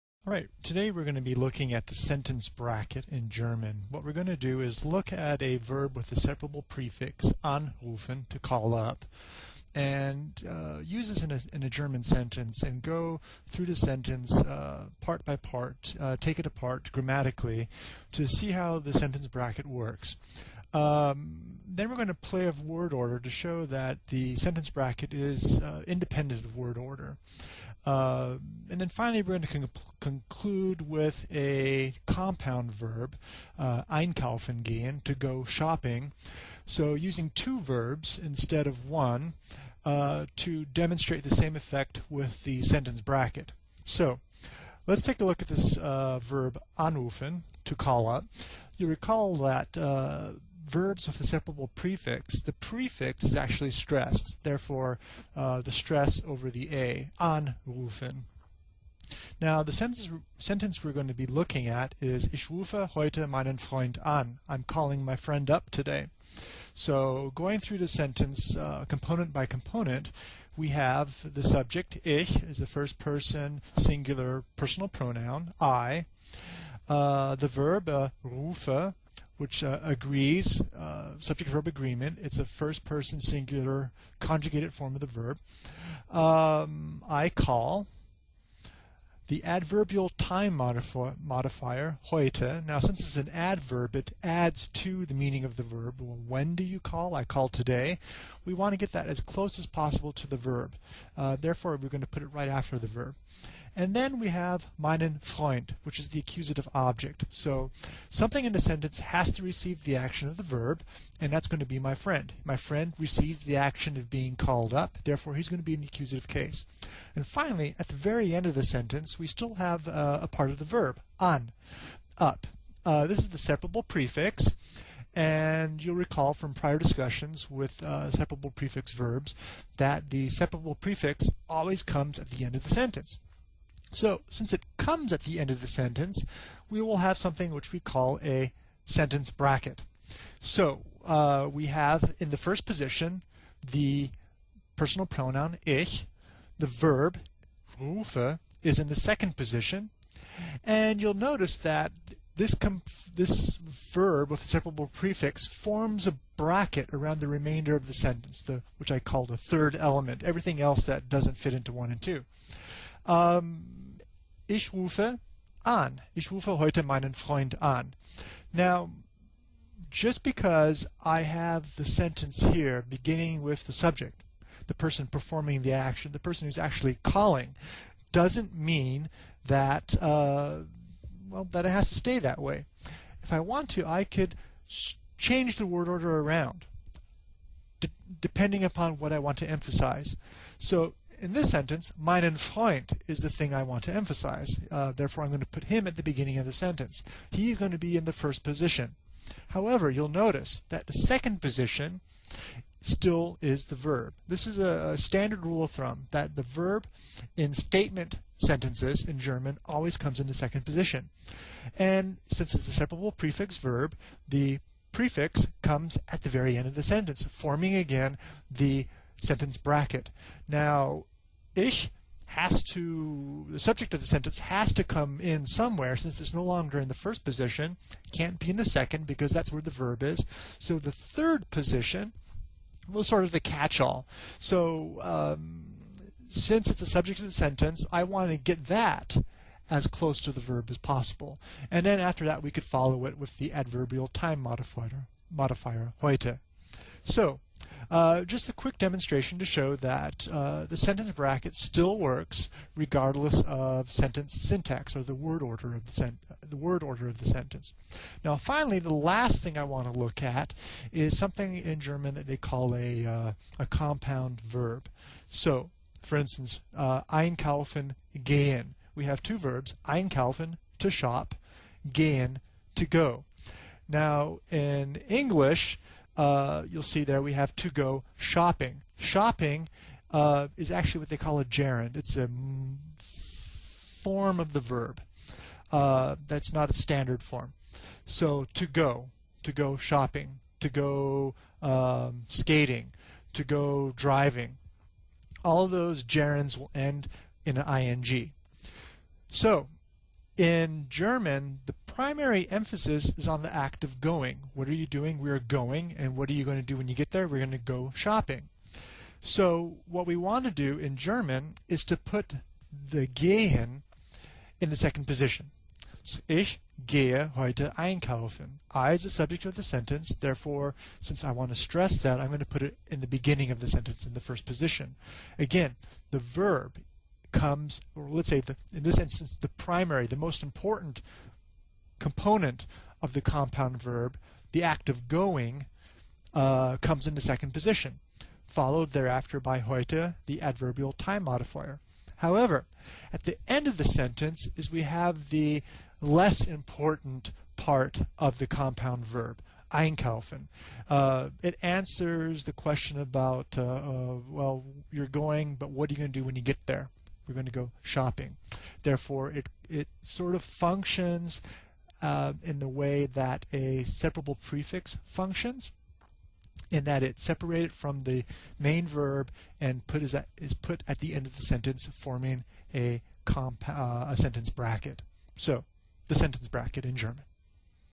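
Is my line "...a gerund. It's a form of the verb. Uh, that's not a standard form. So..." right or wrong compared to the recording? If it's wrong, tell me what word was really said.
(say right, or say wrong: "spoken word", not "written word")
right.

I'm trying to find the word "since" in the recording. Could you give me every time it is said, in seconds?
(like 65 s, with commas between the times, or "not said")
92 s, 134 s, 212 s, 225 s, 236 s, 320 s.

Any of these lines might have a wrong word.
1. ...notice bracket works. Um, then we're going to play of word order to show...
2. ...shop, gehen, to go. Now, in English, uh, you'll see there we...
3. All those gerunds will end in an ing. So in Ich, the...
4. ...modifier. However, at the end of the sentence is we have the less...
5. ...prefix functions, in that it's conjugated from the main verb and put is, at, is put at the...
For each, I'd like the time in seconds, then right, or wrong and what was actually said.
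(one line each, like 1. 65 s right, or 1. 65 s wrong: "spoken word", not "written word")
1. 18 s wrong: "sentence", not "notice"
2. 270 s right
3. 295 s wrong: "German", not "Ich"
4. 341 s right
5. 364 s wrong: "separated", not "conjugated".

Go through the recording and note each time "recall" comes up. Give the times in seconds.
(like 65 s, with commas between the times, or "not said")
48 s, 125 s.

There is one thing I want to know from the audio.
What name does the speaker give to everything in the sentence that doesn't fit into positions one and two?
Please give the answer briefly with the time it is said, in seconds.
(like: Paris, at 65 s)
the third element, at 159 s.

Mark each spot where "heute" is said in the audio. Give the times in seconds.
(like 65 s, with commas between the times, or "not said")
62 s, 92 s, 166 s, 246 s, 317 s, 339 s.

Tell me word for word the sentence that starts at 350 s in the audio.
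Uh, it answers the question about, uh, uh, well, you're going, but what are you going to do when you get there?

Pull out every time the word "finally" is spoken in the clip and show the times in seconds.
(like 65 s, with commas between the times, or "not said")
28 s, 117 s, 258 s.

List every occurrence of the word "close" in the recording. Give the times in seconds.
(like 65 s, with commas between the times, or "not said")
99 s, 239 s.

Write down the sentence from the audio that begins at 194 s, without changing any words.
Uh, therefore, I'm going to put him at the beginning of the sentence.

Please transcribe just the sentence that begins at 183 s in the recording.
If I want to, I could change the word order around depending upon what I want to emphasize.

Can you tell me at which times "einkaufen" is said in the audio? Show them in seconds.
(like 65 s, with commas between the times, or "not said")
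33 s, 267 s, 317 s, 349 s.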